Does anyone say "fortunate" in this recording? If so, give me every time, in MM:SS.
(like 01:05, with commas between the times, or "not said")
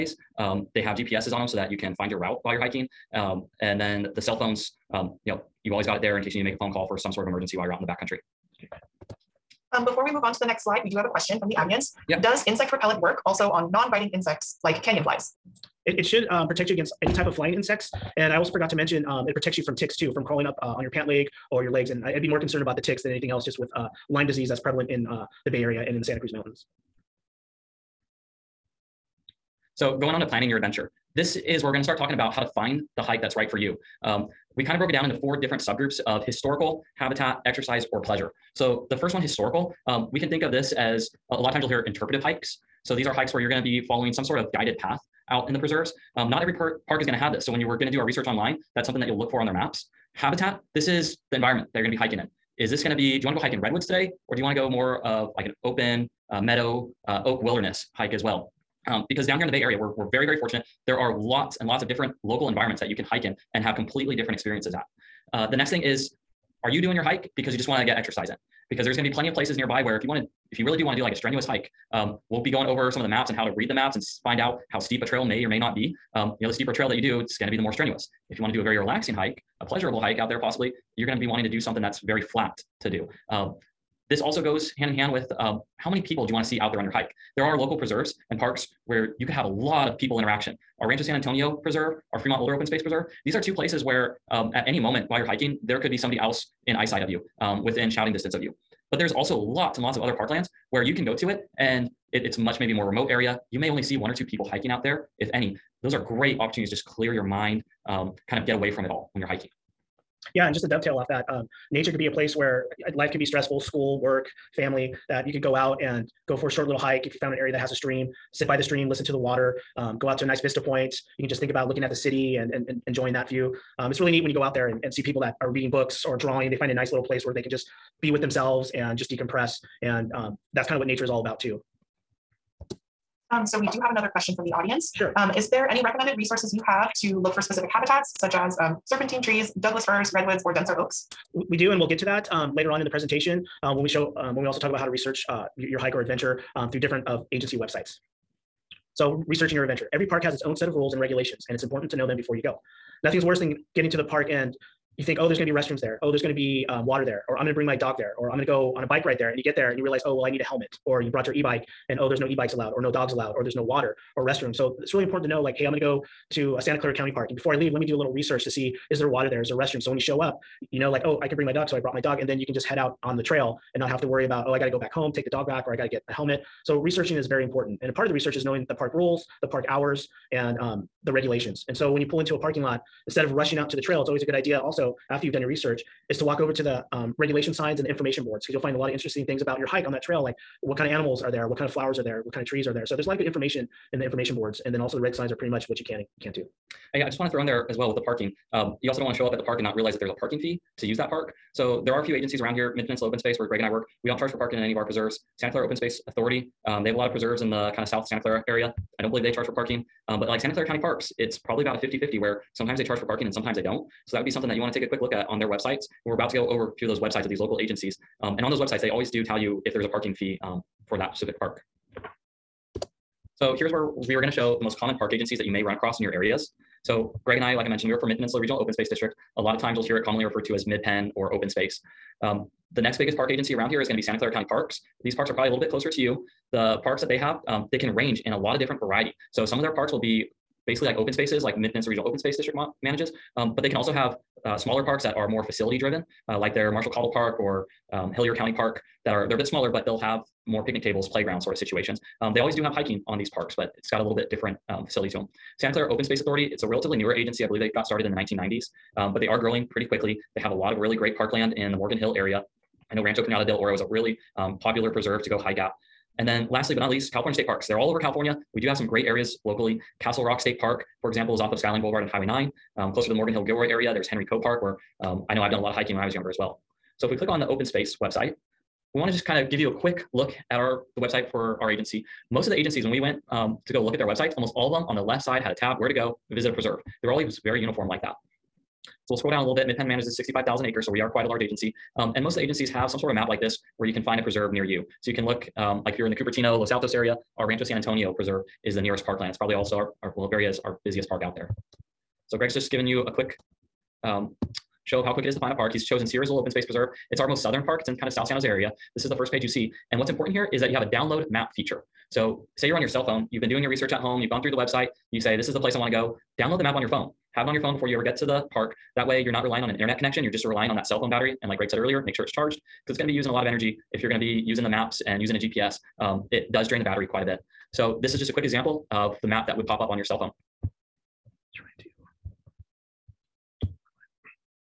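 01:00.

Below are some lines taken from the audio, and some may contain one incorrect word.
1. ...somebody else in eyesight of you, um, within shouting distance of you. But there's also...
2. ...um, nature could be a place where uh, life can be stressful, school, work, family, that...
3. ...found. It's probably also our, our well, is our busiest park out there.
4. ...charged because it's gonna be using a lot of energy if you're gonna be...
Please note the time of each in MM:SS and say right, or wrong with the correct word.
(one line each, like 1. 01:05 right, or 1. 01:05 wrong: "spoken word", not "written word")
1. 01:35 right
2. 01:51 right
3. 04:59 wrong: "parkland", not "found"
4. 05:22 right.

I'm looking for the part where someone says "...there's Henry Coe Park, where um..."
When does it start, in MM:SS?
04:33.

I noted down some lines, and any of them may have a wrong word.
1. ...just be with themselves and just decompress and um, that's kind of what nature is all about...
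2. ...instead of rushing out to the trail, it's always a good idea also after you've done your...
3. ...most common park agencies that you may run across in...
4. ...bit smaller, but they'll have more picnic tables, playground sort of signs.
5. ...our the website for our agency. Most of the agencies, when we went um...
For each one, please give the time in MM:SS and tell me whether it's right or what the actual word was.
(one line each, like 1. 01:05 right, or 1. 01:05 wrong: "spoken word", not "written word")
1. 02:07 right
2. 03:03 right
3. 03:44 right
4. 04:09 wrong: "situations", not "signs"
5. 04:40 right.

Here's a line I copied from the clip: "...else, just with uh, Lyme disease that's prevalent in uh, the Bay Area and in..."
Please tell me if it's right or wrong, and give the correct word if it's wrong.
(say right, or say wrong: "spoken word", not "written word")
right.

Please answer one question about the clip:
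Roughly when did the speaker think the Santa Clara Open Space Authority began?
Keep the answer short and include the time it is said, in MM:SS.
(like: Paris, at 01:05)
1990s, at 04:18.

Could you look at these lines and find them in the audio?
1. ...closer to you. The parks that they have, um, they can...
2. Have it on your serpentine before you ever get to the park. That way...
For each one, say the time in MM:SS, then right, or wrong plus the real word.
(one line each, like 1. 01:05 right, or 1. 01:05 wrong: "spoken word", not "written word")
1. 03:55 right
2. 05:17 wrong: "phone", not "serpentine".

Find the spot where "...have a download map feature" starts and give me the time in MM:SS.
05:10.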